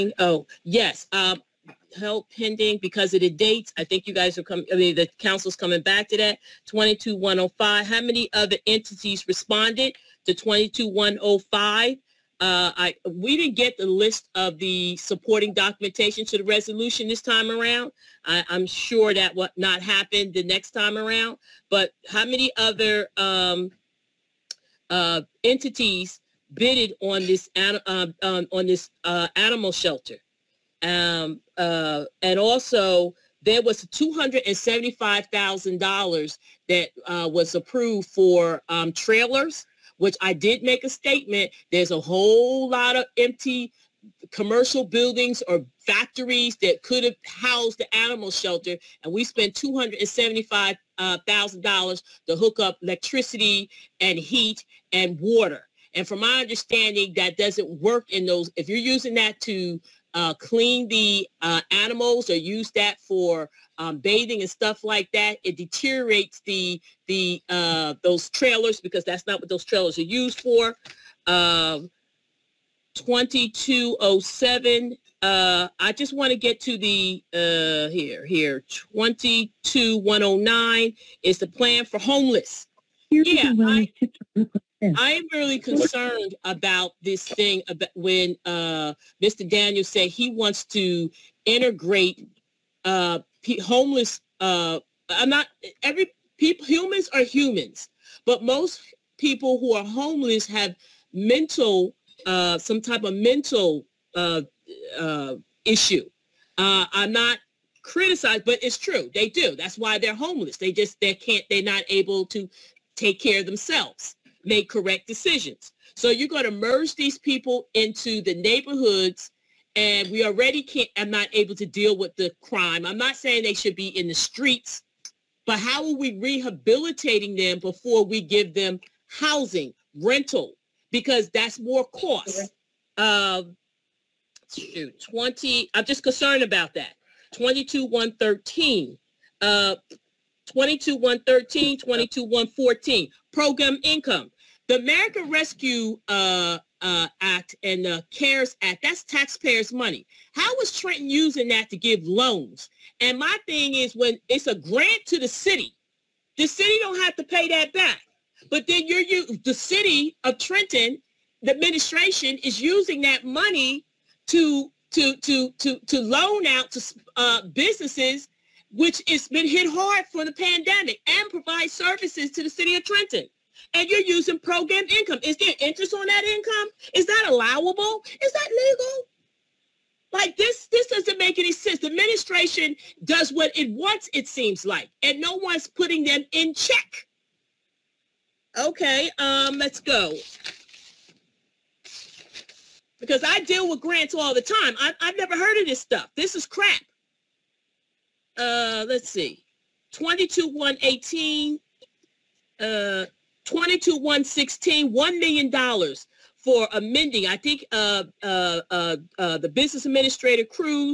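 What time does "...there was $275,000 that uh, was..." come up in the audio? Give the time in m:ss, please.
0:33.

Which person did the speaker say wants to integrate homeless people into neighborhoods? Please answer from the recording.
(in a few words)
Mr. Daniels.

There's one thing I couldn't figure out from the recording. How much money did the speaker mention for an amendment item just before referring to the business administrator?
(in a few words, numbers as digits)
$1 million.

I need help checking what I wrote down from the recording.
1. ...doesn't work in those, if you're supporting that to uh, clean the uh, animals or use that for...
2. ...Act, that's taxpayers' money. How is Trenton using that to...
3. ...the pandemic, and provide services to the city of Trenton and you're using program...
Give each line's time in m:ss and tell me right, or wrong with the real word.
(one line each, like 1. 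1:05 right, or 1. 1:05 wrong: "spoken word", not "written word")
1. 0:57 wrong: "using", not "supporting"
2. 2:28 right
3. 2:50 right.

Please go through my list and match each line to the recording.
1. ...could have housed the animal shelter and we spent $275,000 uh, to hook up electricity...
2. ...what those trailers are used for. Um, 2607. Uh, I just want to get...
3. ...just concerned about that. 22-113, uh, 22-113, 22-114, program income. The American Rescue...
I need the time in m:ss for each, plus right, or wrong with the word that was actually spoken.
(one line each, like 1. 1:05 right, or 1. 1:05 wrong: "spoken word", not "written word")
1. 0:46 right
2. 1:09 wrong: "2207", not "2607"
3. 2:15 right.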